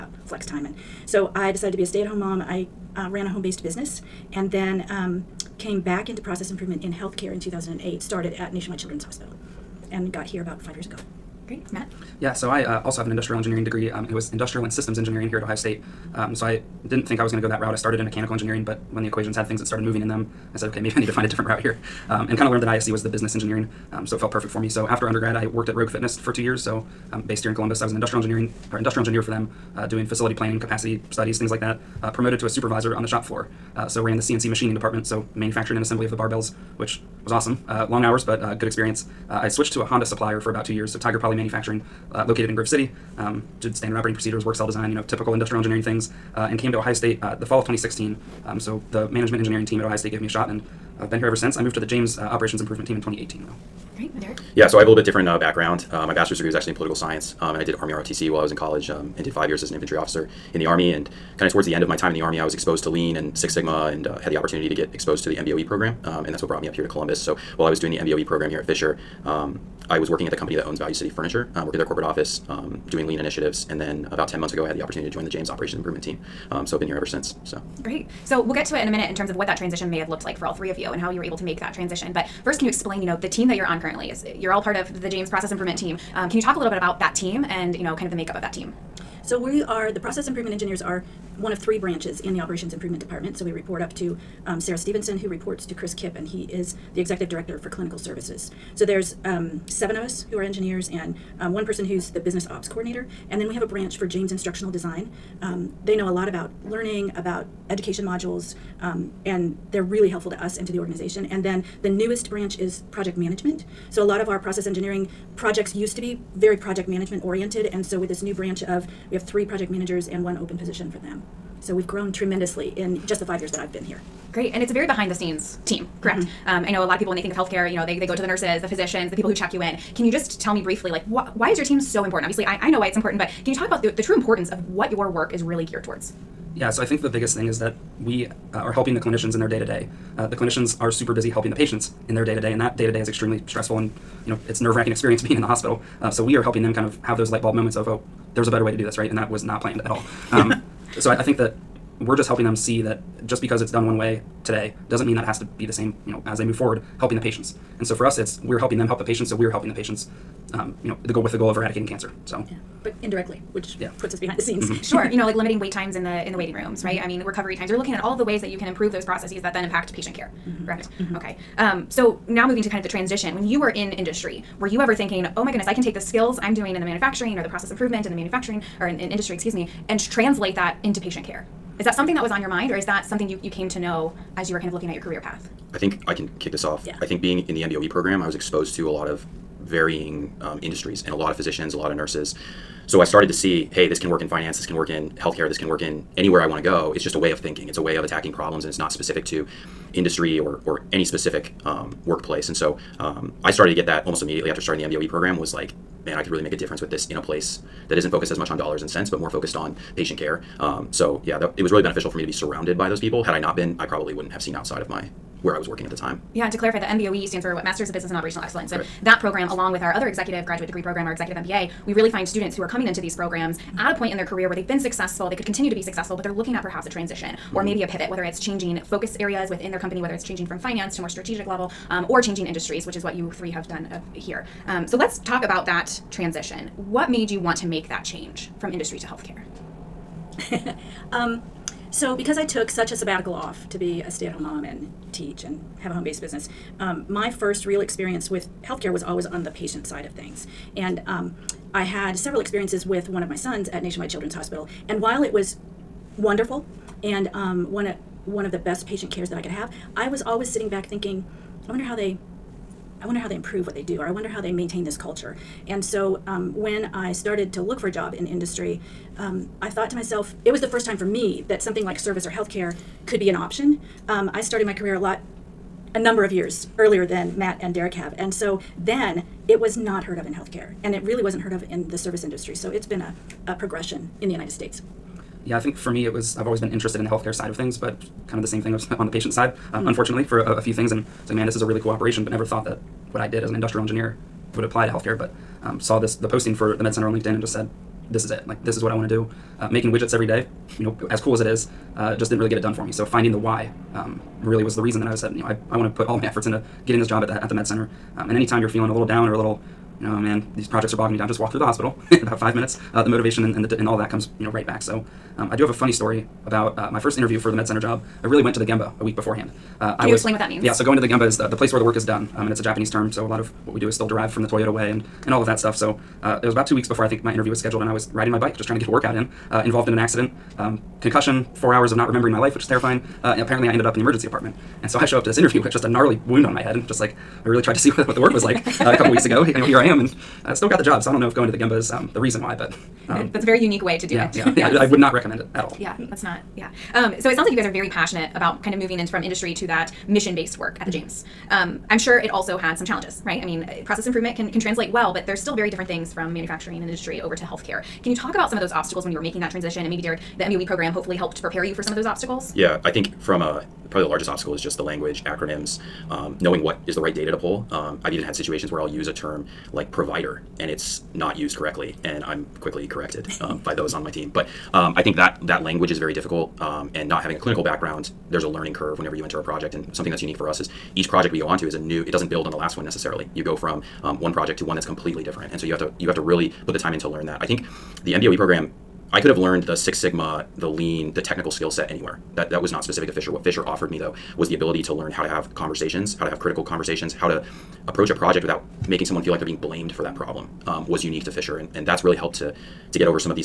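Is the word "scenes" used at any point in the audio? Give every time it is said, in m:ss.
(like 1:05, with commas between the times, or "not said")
2:05, 2:44.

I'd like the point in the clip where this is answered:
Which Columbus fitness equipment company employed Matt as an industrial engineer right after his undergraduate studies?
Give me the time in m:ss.
0:25.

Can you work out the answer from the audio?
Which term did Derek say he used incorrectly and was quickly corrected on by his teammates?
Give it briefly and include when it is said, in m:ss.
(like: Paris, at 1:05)
Provider, at 6:09.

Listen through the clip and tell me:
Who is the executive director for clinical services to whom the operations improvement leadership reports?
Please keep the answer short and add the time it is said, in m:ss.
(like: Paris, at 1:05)
Chris Kipp, at 1:35.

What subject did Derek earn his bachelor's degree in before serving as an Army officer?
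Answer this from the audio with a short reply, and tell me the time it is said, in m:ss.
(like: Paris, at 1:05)
Political science, at 0:56.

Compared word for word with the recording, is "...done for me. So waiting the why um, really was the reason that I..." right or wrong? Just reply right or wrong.
wrong.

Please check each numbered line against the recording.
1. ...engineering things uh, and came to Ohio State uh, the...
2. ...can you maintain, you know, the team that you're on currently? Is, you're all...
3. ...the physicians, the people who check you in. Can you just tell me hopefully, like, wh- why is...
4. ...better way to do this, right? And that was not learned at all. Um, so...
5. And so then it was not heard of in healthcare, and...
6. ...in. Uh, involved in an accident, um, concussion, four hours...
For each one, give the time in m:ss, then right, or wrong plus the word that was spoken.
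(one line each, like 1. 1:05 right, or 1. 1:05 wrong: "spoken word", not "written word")
1. 0:45 right
2. 1:22 wrong: "explain", not "maintain"
3. 2:08 wrong: "briefly", not "hopefully"
4. 2:28 wrong: "planned", not "learned"
5. 4:38 right
6. 5:29 right.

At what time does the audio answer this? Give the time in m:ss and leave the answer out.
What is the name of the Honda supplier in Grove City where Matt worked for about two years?
0:40.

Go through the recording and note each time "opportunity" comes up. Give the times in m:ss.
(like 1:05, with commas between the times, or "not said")
1:04, 1:14.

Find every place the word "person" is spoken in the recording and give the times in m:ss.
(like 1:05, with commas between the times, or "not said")
1:41.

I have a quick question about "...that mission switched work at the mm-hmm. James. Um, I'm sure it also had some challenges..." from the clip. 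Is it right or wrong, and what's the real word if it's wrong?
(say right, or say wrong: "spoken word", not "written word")
wrong: "based", not "switched".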